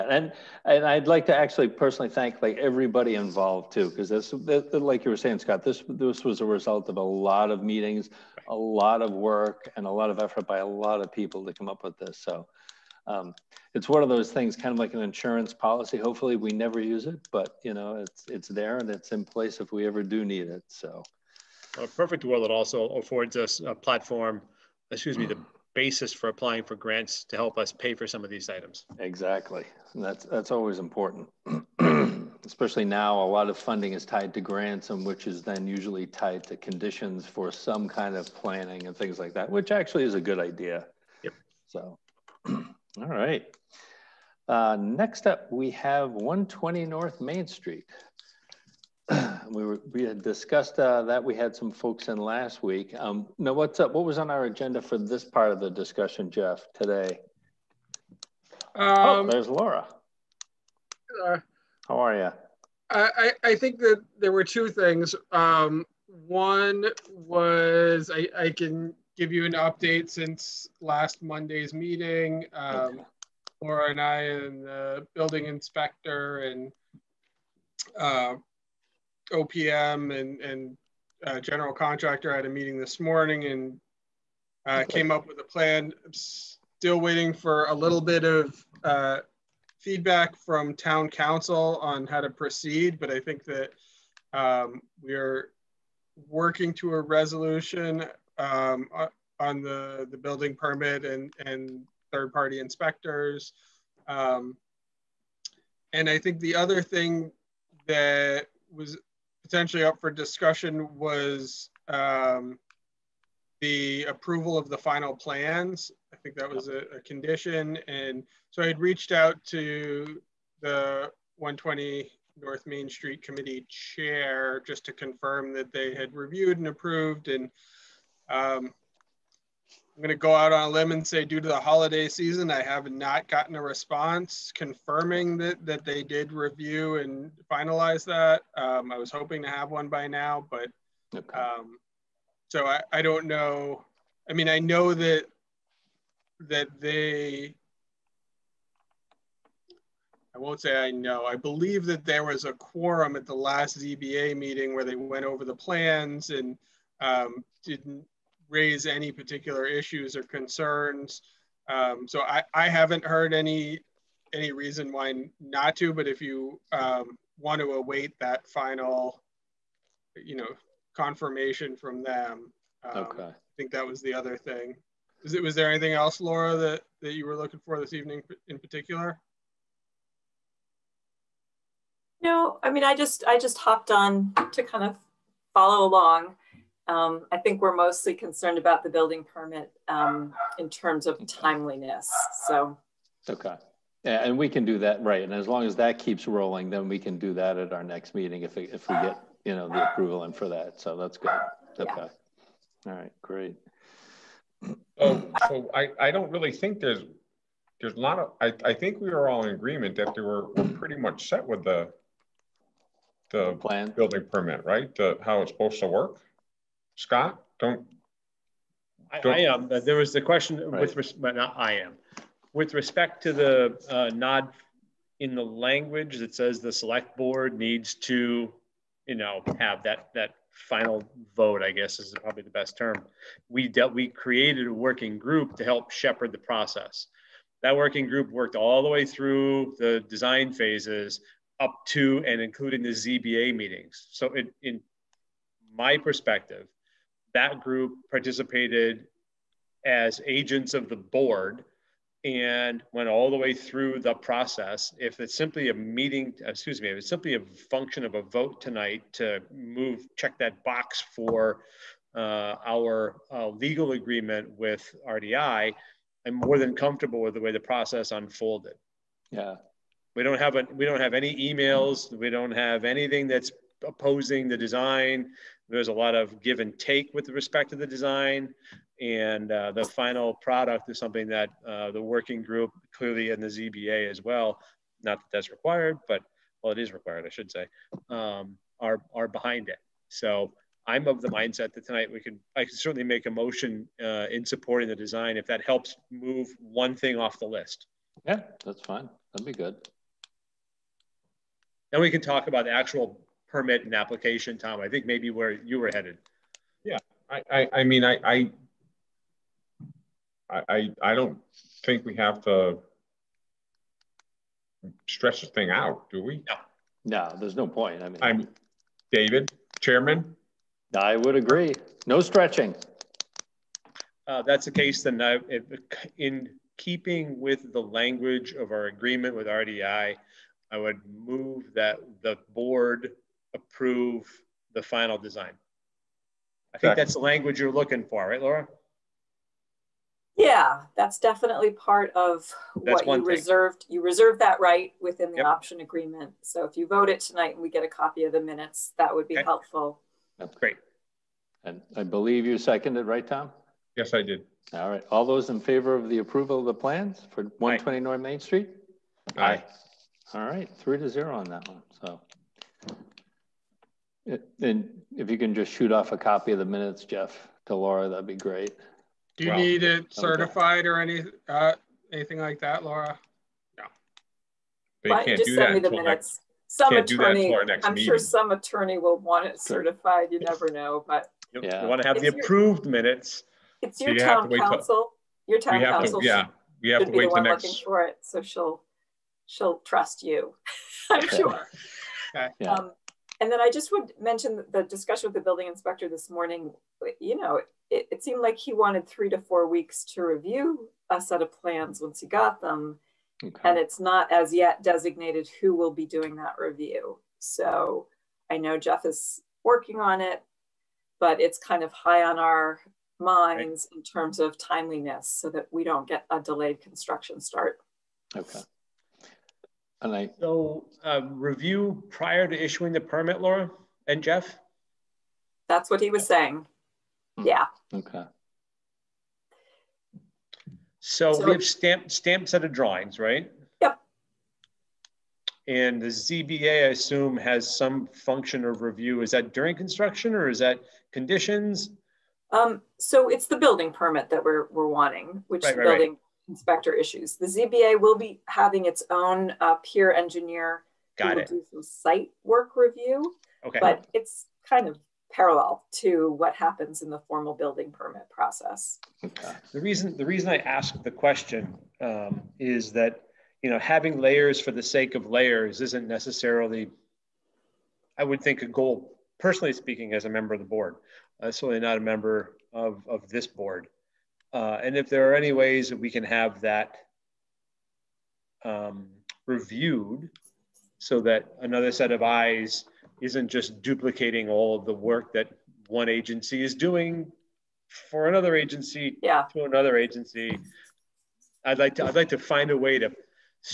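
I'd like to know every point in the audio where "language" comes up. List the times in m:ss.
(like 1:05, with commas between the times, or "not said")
3:45, 5:27, 5:37.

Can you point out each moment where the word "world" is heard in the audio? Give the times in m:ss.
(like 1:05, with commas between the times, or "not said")
0:22.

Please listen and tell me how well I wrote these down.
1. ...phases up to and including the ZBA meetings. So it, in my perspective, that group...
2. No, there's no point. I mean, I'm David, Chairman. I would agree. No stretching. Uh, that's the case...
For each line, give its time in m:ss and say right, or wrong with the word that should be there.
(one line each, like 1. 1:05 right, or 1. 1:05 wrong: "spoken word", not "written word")
1. 4:00 right
2. 5:17 right.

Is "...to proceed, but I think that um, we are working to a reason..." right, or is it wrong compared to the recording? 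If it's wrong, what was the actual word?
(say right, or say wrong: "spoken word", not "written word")
wrong: "resolution", not "reason".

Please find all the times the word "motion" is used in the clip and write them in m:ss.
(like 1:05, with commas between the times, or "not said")
4:53.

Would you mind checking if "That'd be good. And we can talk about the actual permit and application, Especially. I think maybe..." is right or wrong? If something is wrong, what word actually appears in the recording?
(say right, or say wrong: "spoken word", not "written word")
wrong: "Tom", not "Especially".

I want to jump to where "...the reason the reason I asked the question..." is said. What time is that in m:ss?
7:39.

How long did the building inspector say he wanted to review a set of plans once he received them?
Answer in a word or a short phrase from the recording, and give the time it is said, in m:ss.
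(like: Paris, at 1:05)
3 to 4 weeks, at 6:39.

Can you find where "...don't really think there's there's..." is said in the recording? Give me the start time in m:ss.
3:26.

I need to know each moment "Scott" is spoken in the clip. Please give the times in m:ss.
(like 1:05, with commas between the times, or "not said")
0:05, 3:36.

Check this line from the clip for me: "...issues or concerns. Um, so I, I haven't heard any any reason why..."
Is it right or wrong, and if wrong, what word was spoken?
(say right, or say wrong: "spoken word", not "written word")
right.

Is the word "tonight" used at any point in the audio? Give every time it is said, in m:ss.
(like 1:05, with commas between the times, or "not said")
4:18, 4:51, 5:47.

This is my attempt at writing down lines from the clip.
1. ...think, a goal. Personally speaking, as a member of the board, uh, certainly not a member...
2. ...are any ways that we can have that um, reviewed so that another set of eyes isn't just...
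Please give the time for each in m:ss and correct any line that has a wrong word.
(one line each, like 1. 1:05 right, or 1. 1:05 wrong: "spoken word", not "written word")
1. 7:48 right
2. 7:55 right.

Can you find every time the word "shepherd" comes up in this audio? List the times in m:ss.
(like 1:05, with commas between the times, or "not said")
3:55.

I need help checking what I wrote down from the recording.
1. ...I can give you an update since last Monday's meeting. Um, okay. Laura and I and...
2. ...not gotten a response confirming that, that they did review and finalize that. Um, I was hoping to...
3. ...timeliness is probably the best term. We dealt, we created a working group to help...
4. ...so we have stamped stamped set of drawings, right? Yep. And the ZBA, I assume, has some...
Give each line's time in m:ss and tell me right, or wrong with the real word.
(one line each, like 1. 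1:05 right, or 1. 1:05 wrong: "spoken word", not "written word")
1. 1:08 right
2. 2:12 right
3. 3:51 wrong: "guess", not "timeliness"
4. 7:11 right.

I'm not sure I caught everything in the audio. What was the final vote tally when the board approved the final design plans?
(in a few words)
3 to 0.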